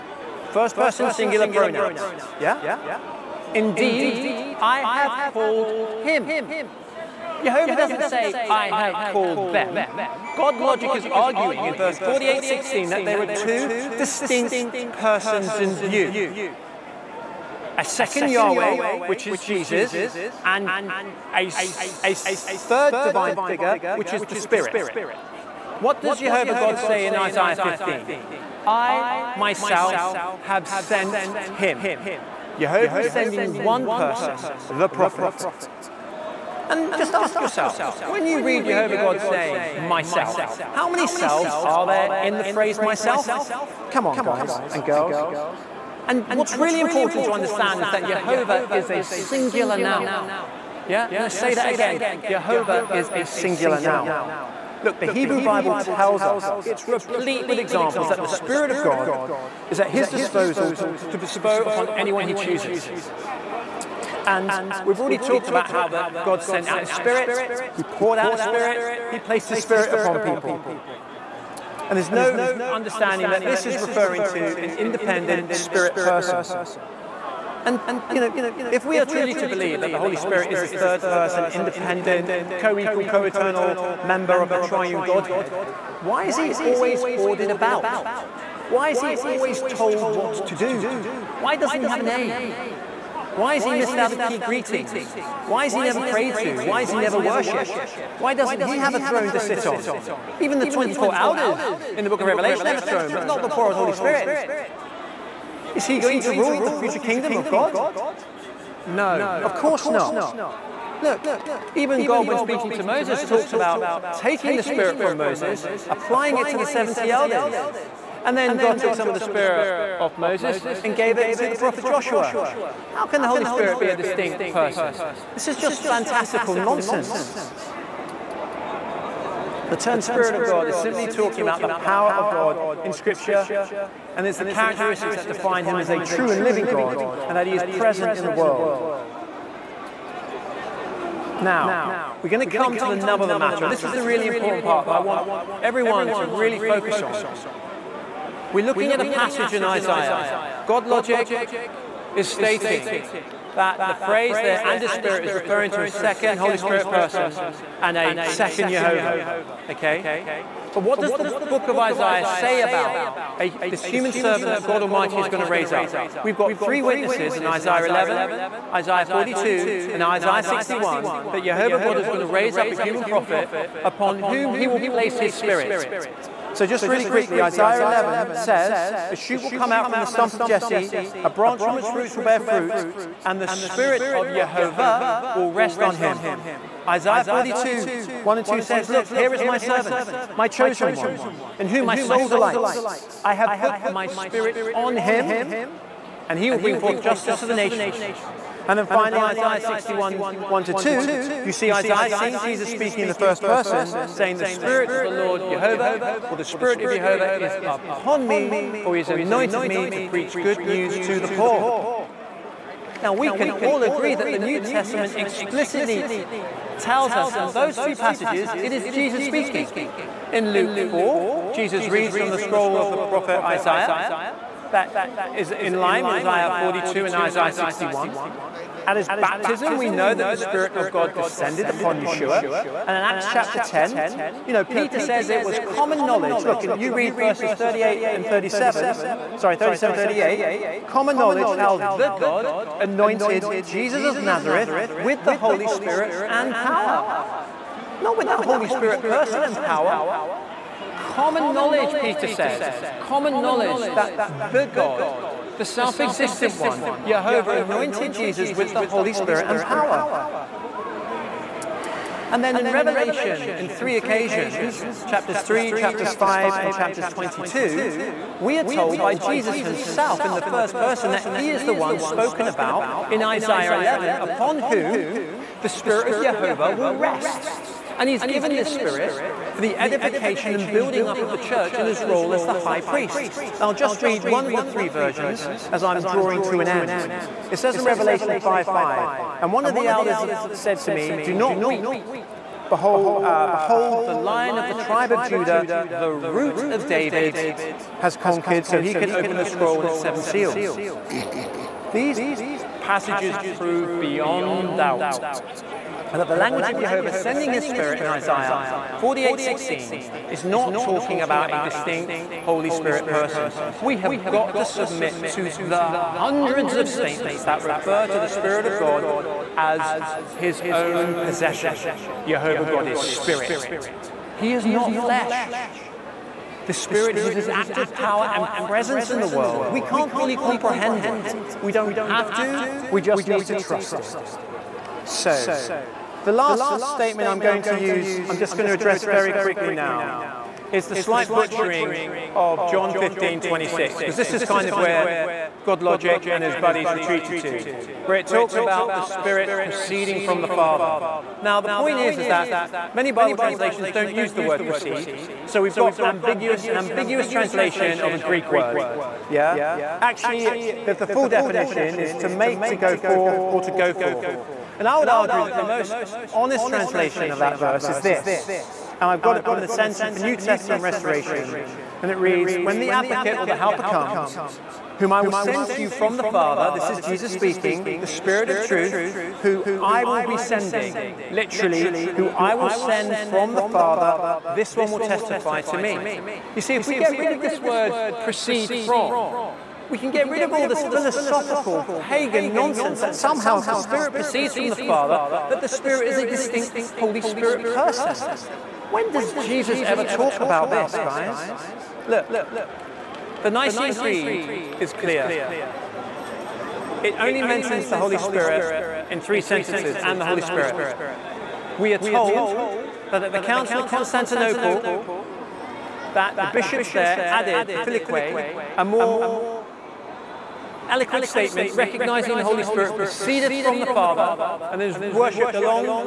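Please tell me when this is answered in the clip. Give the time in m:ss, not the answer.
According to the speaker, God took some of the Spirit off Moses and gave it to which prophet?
2:01.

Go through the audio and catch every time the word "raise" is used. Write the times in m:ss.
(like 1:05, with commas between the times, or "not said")
2:45, 2:52.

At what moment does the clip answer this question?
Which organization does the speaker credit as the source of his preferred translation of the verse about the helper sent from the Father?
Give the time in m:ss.
6:09.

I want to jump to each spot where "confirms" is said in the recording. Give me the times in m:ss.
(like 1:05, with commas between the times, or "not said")
not said.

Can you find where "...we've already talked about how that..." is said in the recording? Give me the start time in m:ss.
1:04.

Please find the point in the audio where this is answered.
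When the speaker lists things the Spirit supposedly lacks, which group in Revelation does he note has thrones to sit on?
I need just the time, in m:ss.
1:40.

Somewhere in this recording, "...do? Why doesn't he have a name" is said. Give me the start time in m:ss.
1:30.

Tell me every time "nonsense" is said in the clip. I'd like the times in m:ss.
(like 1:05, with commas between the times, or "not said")
2:06, 6:32.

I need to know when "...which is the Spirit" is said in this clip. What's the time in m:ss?
0:23.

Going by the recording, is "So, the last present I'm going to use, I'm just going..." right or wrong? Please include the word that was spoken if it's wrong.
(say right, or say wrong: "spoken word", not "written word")
wrong: "statement", not "present".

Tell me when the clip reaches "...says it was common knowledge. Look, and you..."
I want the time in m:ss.
3:54.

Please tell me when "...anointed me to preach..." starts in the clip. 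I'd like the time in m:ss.
3:29.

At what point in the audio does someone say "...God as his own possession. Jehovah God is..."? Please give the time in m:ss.
5:18.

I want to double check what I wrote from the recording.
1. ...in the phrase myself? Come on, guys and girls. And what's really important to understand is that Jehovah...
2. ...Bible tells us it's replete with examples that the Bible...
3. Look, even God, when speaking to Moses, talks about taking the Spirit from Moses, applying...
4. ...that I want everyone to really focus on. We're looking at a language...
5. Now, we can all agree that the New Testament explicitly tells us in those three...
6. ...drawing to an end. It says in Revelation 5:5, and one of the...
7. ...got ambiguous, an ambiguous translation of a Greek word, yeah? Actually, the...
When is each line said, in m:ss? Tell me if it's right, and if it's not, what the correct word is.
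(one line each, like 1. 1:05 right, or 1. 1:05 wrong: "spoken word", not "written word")
1. 0:42 right
2. 0:55 wrong: "Spirit", not "Bible"
3. 1:51 right
4. 2:24 wrong: "passage", not "language"
5. 3:33 right
6. 4:46 right
7. 5:55 right.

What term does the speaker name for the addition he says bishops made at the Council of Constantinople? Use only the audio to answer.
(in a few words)
Filioque.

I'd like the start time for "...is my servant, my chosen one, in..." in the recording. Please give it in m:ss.
3:09.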